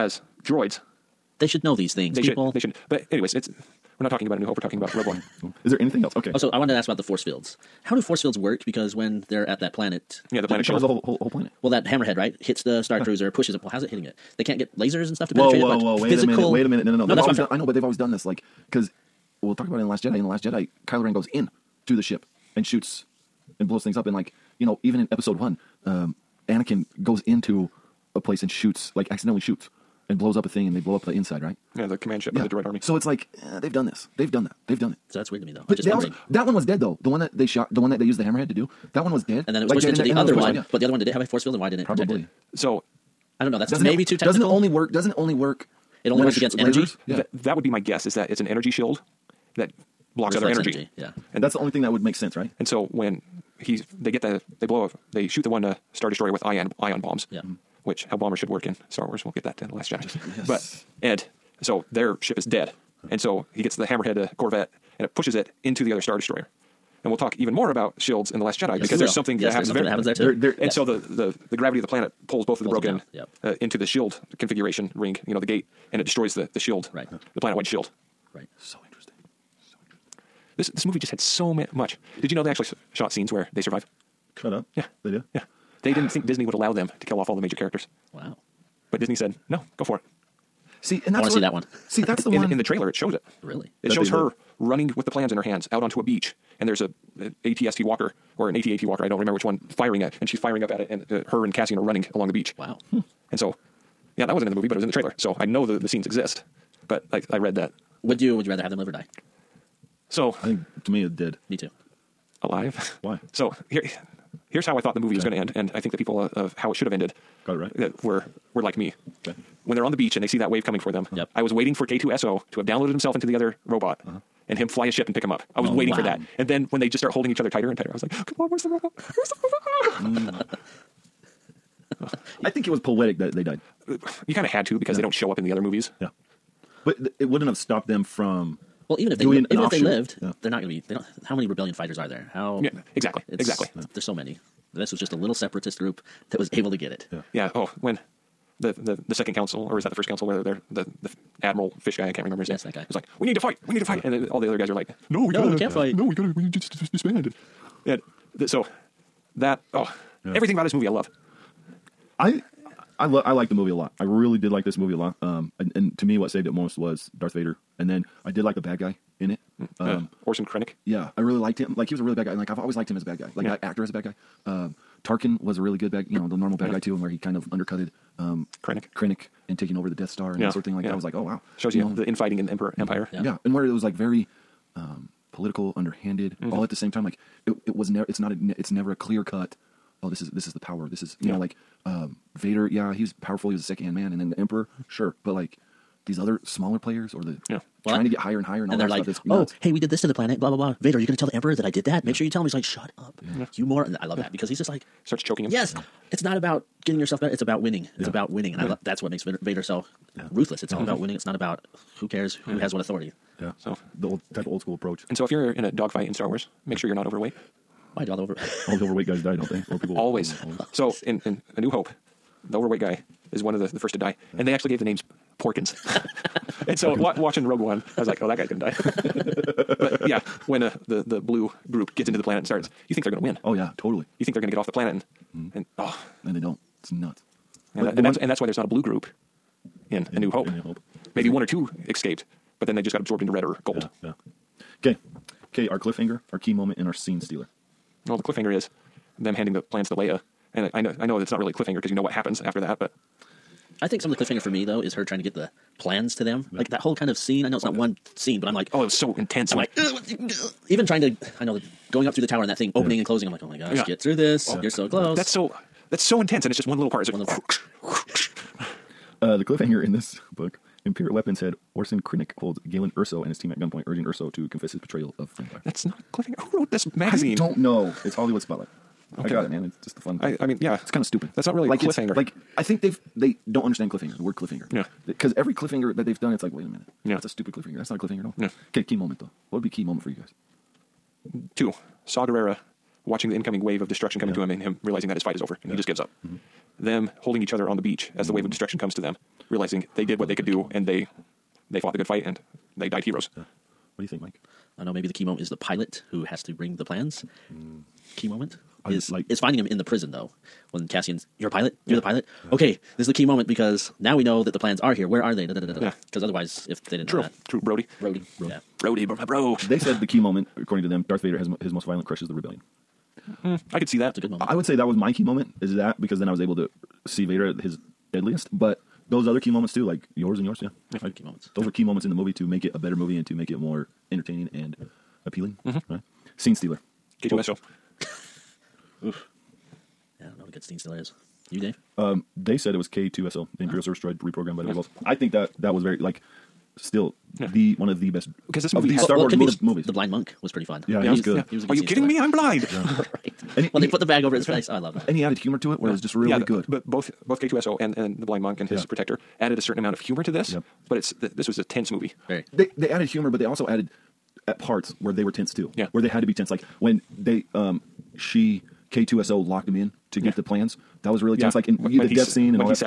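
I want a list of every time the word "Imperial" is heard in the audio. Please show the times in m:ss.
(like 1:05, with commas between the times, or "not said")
4:30, 5:43.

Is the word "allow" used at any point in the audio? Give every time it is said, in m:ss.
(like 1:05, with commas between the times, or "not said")
1:26.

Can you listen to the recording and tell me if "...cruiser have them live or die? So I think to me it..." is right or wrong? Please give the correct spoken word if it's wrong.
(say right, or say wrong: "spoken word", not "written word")
wrong: "rather", not "cruiser".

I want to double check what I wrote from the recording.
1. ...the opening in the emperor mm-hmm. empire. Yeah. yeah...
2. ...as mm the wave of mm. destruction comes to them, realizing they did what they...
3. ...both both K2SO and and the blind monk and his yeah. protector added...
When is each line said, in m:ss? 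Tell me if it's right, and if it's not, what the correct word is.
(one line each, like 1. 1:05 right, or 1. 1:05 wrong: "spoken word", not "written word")
1. 3:01 wrong: "infighting", not "opening"
2. 4:58 right
3. 5:56 right.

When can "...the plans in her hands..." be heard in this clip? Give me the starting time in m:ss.
1:35.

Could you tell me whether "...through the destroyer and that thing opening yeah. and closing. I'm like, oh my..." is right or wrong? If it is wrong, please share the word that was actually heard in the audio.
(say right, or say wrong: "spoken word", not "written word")
wrong: "tower", not "destroyer".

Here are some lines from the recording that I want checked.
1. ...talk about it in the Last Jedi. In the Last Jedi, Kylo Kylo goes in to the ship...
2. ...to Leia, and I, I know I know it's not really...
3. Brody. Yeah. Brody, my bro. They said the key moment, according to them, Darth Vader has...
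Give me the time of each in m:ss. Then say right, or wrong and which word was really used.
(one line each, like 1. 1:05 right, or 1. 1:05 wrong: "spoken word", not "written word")
1. 0:19 wrong: "Ren", not "Kylo"
2. 4:09 right
3. 5:18 right.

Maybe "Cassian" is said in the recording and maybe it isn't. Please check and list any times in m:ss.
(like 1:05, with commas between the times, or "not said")
1:41, 5:10.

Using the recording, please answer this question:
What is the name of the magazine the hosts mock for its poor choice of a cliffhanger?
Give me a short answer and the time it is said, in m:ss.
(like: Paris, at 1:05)
Hollywood Spotlight, at 4:38.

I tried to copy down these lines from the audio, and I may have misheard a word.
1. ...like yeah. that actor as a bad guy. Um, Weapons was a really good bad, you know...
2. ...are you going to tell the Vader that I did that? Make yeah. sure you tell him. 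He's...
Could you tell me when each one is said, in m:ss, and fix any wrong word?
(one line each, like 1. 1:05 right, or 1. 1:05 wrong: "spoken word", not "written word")
1. 2:53 wrong: "Tarkin", not "Weapons"
2. 3:20 wrong: "Emperor", not "Vader".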